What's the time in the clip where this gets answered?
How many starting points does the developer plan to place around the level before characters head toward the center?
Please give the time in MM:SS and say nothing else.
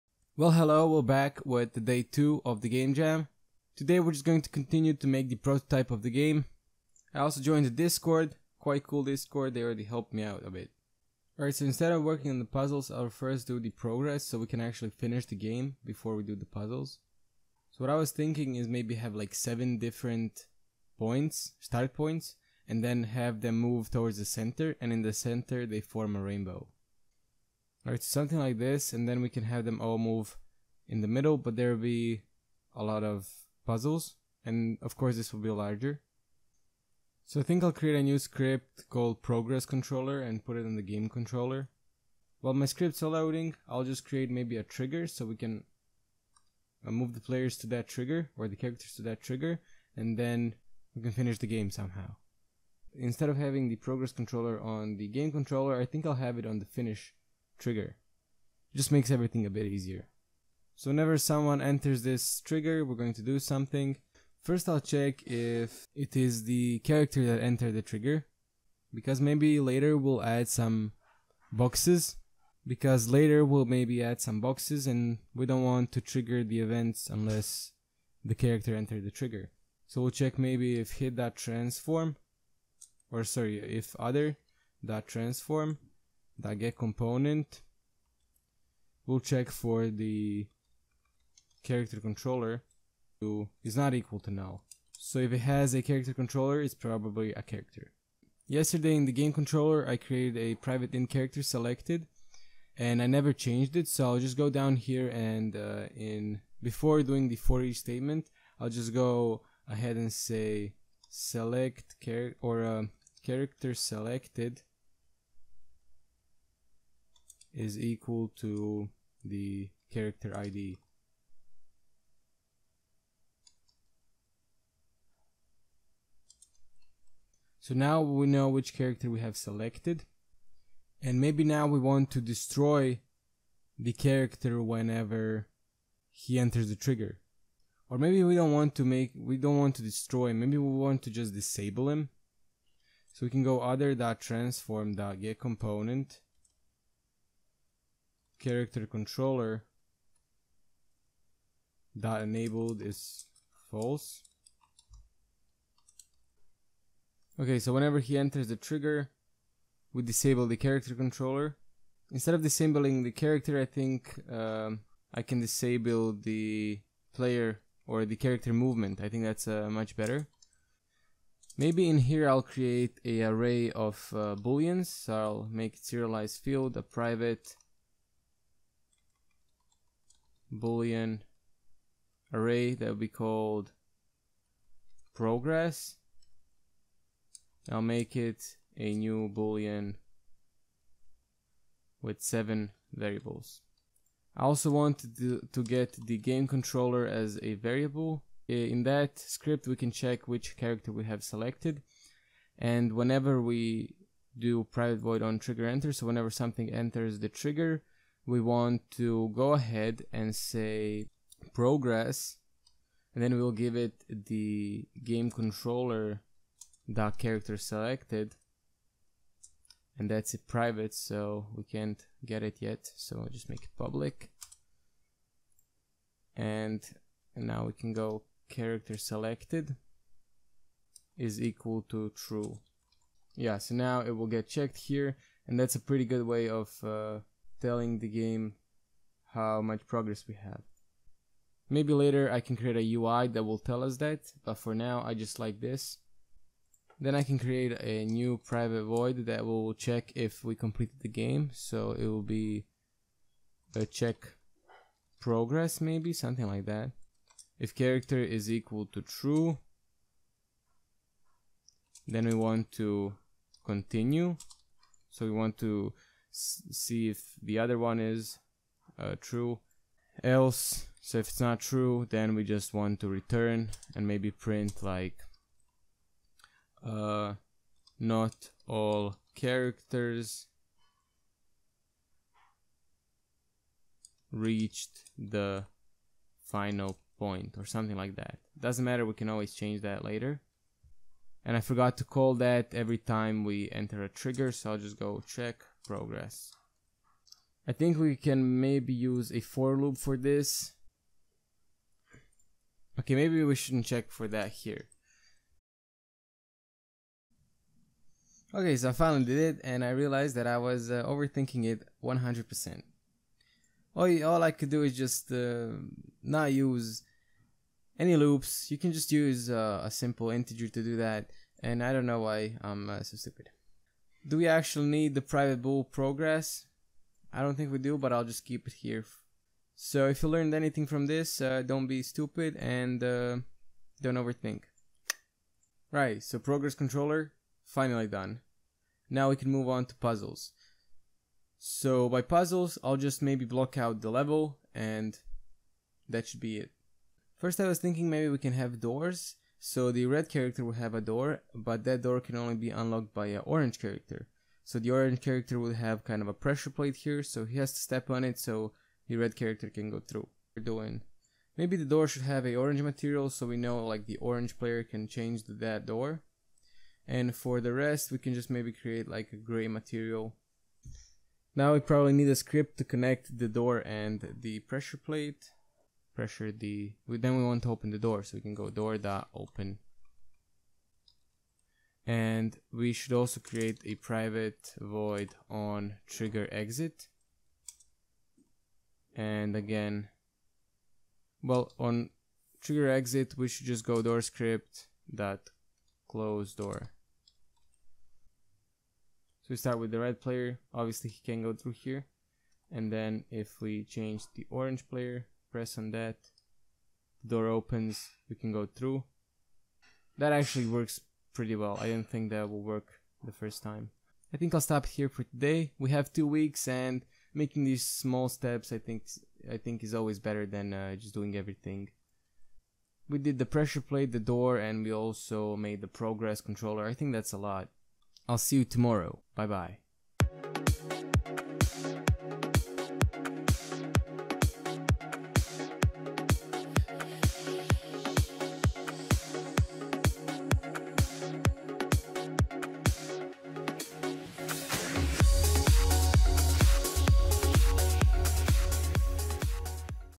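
00:19.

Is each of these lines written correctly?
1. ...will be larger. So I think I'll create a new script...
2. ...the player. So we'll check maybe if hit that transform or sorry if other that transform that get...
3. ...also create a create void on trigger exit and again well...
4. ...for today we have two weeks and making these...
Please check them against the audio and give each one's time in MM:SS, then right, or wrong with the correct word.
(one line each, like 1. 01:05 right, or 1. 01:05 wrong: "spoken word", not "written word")
1. 00:35 right
2. 01:19 wrong: "trigger", not "player"
3. 06:23 wrong: "private", not "create"
4. 06:55 right.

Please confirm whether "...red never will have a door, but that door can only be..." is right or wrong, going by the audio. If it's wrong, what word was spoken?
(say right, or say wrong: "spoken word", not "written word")
wrong: "character", not "never".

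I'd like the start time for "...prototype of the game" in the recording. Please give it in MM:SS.
00:05.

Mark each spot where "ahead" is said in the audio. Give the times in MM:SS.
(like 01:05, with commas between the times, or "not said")
01:49, 03:29.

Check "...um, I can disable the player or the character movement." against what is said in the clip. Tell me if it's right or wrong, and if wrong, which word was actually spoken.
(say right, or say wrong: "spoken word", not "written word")
right.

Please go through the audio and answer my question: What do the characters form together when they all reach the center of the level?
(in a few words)
a rainbow.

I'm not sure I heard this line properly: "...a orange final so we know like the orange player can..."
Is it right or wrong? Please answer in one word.
wrong.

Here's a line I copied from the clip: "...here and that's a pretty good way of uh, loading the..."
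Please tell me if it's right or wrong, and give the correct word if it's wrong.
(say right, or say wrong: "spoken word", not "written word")
wrong: "telling", not "loading".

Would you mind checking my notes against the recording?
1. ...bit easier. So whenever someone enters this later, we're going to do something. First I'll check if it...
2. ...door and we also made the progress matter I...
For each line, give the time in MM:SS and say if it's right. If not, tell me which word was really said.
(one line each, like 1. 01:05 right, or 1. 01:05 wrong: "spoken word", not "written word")
1. 00:59 wrong: "trigger", not "later"
2. 07:04 wrong: "controller", not "matter".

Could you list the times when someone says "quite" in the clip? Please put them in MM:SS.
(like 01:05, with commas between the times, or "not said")
00:08.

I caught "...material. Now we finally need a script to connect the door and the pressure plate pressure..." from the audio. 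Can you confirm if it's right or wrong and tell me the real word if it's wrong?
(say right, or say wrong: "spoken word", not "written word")
wrong: "probably", not "finally".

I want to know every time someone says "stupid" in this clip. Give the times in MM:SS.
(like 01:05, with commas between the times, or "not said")
05:23, 05:32.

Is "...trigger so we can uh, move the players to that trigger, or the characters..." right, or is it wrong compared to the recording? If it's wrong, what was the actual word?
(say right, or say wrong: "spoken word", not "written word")
right.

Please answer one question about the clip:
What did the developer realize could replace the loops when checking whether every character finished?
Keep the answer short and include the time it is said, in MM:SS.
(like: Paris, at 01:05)
a simple integer, at 05:19.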